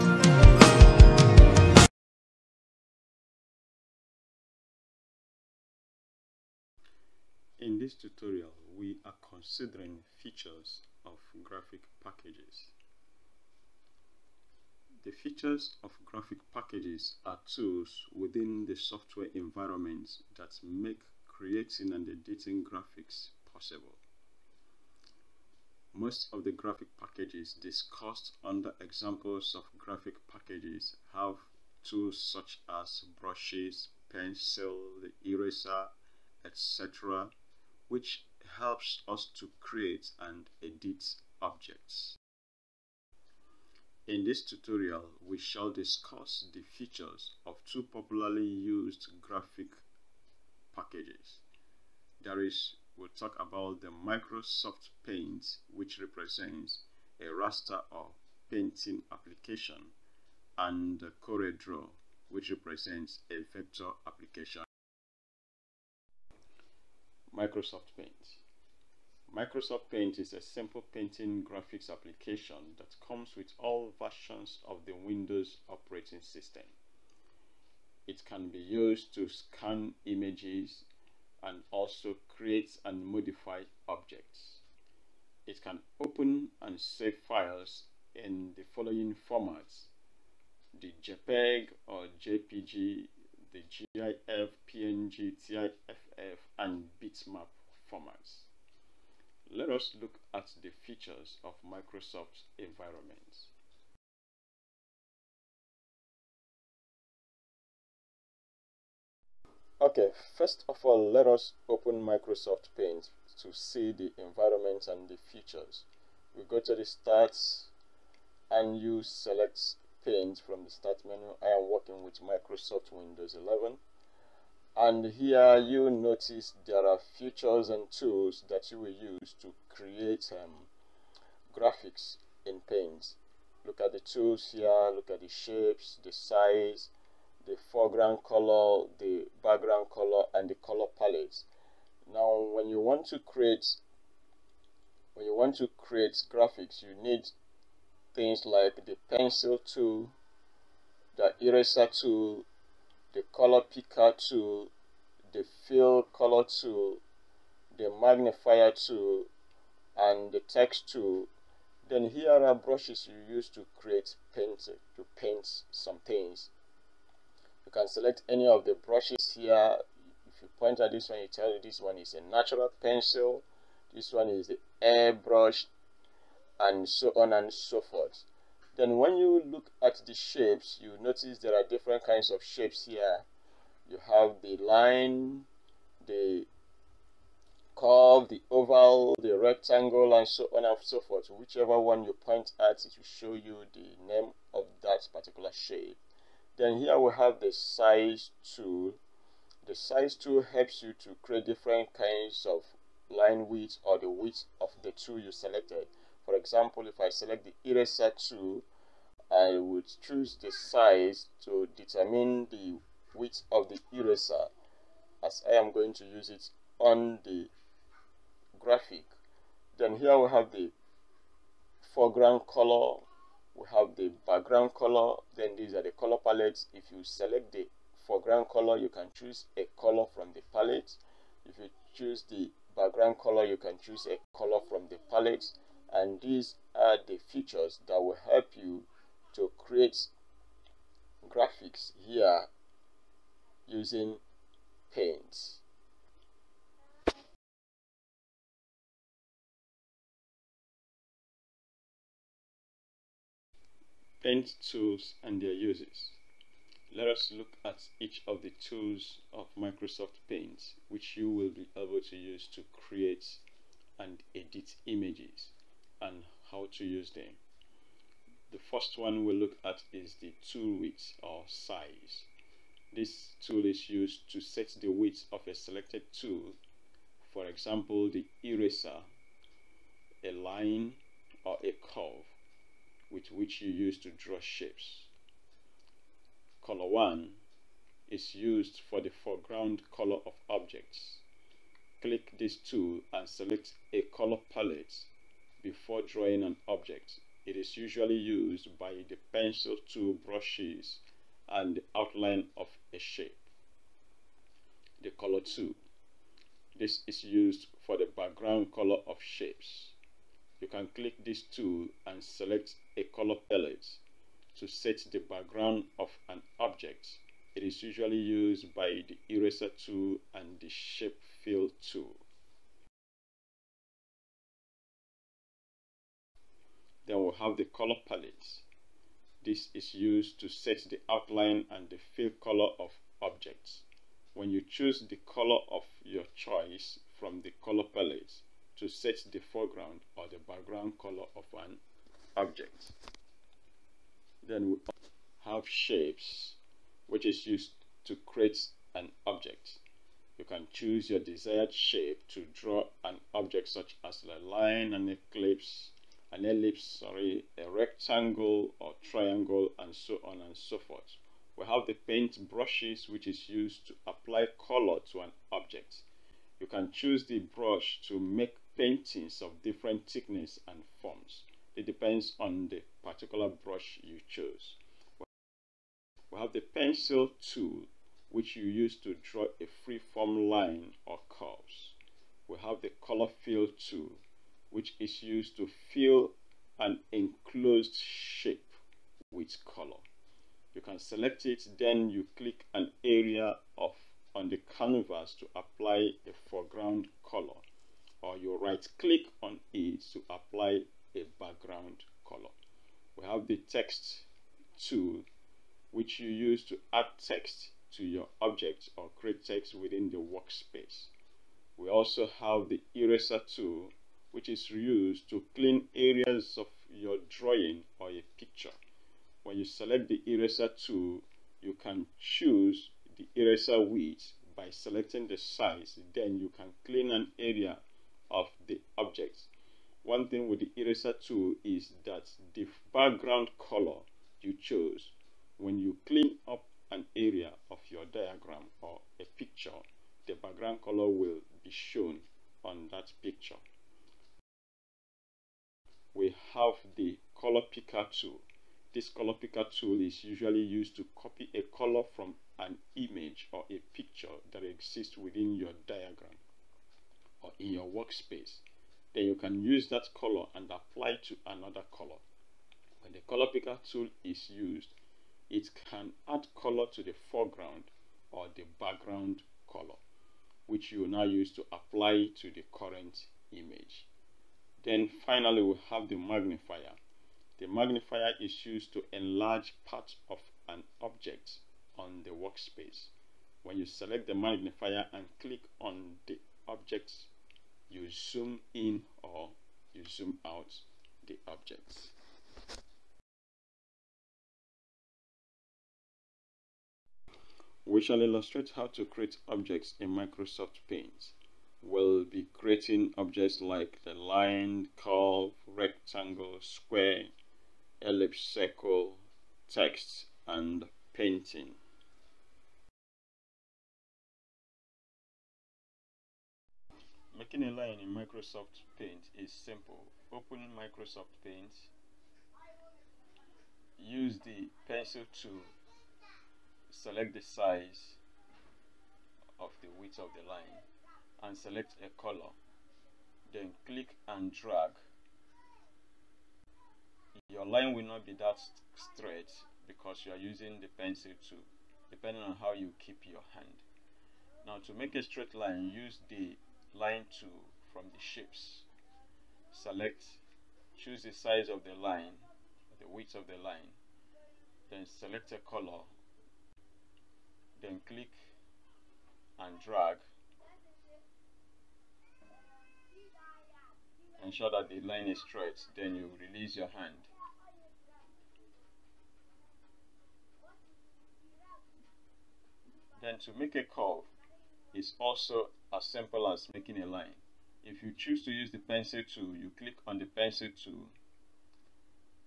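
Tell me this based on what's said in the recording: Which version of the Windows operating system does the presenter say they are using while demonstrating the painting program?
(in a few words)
Windows 11.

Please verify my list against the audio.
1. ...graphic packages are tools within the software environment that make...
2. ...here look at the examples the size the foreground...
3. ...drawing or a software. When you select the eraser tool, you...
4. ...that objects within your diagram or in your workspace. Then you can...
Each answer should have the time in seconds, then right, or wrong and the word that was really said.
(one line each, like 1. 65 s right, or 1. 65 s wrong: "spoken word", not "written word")
1. 16 s right
2. 134 s wrong: "shapes", not "examples"
3. 417 s wrong: "picture", not "software"
4. 454 s wrong: "exists", not "objects".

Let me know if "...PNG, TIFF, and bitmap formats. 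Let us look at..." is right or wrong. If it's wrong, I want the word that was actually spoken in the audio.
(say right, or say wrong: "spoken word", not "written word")
right.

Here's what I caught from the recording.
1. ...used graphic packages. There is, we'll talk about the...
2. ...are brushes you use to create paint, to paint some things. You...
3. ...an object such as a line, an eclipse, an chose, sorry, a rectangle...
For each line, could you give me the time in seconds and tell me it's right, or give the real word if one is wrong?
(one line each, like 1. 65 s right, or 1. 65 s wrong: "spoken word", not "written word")
1. 48 s right
2. 162 s right
3. 353 s wrong: "ellipse", not "chose".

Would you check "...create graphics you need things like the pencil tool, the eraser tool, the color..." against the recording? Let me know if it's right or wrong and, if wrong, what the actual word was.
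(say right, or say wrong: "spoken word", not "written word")
right.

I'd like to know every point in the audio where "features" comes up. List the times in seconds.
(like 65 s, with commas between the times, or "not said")
10 s, 15 s, 46 s, 100 s, 115 s, 127 s, 237 s.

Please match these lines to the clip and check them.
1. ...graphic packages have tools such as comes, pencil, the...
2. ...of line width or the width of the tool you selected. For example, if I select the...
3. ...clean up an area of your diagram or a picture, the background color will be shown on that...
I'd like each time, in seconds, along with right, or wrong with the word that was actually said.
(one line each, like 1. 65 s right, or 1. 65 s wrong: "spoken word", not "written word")
1. 29 s wrong: "brushes", not "comes"
2. 202 s right
3. 436 s right.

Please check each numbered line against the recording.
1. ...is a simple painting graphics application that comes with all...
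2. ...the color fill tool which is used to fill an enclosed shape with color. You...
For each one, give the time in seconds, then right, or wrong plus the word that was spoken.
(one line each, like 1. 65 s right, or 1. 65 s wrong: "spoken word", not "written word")
1. 70 s right
2. 382 s right.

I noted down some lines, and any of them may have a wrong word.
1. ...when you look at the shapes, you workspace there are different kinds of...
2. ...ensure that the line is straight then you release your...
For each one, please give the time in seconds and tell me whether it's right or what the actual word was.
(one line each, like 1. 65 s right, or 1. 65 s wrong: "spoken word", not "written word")
1. 178 s wrong: "notice", not "workspace"
2. 564 s right.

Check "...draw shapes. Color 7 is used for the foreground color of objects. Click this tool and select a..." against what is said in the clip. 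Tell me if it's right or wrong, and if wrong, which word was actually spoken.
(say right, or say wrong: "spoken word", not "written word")
wrong: "1", not "7".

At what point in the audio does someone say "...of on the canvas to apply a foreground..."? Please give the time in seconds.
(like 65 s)
393 s.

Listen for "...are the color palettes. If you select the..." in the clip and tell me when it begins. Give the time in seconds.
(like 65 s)
225 s.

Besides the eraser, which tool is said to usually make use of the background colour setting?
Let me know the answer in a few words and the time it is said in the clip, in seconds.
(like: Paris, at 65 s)
shape fill tool, at 320 s.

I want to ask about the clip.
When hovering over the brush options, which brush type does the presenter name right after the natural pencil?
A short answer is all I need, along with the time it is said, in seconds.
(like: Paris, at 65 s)
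airbrush, at 174 s.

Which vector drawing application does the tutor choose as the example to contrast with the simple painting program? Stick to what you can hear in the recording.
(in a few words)
CorelDRAW.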